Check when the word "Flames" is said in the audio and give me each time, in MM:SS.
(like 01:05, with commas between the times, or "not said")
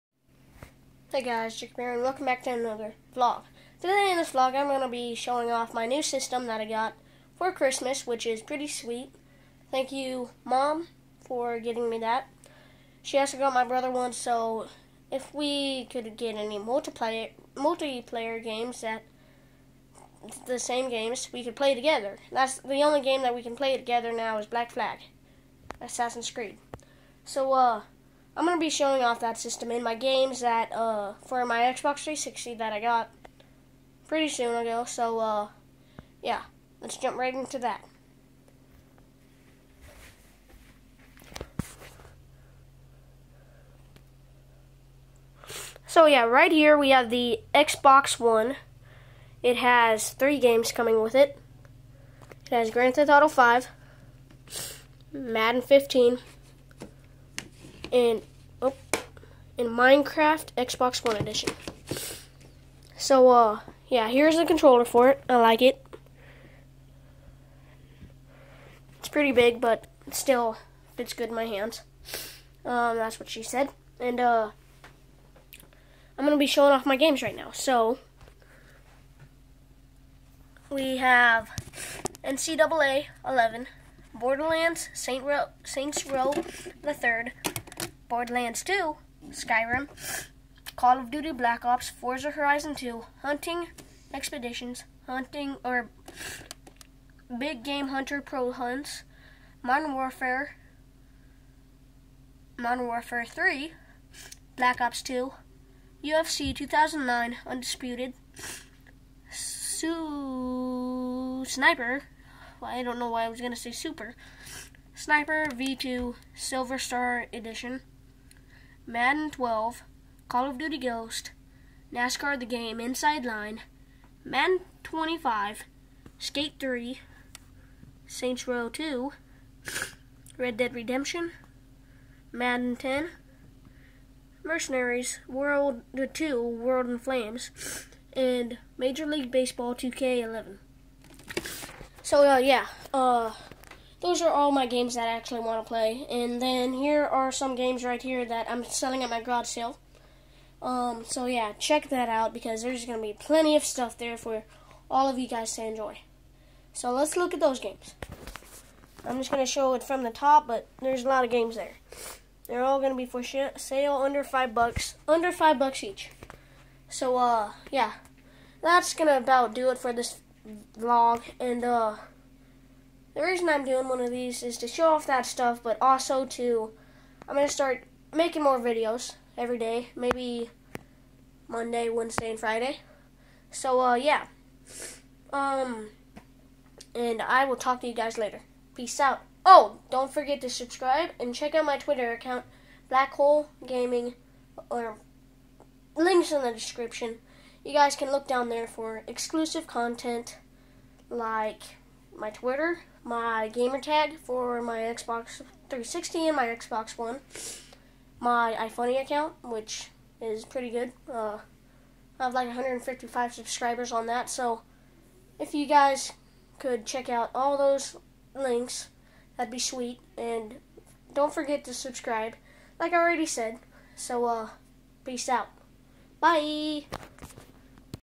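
02:16.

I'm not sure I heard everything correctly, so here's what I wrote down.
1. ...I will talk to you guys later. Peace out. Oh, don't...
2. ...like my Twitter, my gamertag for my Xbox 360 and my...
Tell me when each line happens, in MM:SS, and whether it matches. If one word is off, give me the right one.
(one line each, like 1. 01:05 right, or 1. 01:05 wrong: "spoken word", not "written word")
1. 03:07 right
2. 03:21 right.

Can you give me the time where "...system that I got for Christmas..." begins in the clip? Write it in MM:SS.
00:06.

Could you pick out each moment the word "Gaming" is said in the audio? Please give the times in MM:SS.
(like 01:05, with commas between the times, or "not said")
03:13.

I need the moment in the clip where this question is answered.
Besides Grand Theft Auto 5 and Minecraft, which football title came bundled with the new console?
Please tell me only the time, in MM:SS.
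00:55.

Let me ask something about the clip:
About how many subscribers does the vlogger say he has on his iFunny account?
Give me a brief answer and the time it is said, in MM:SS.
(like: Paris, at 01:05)
155, at 03:32.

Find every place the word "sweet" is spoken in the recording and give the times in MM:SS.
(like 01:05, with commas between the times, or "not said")
00:08, 03:39.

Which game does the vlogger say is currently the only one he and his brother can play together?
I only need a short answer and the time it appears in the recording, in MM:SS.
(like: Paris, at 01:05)
Black Flag, at 00:24.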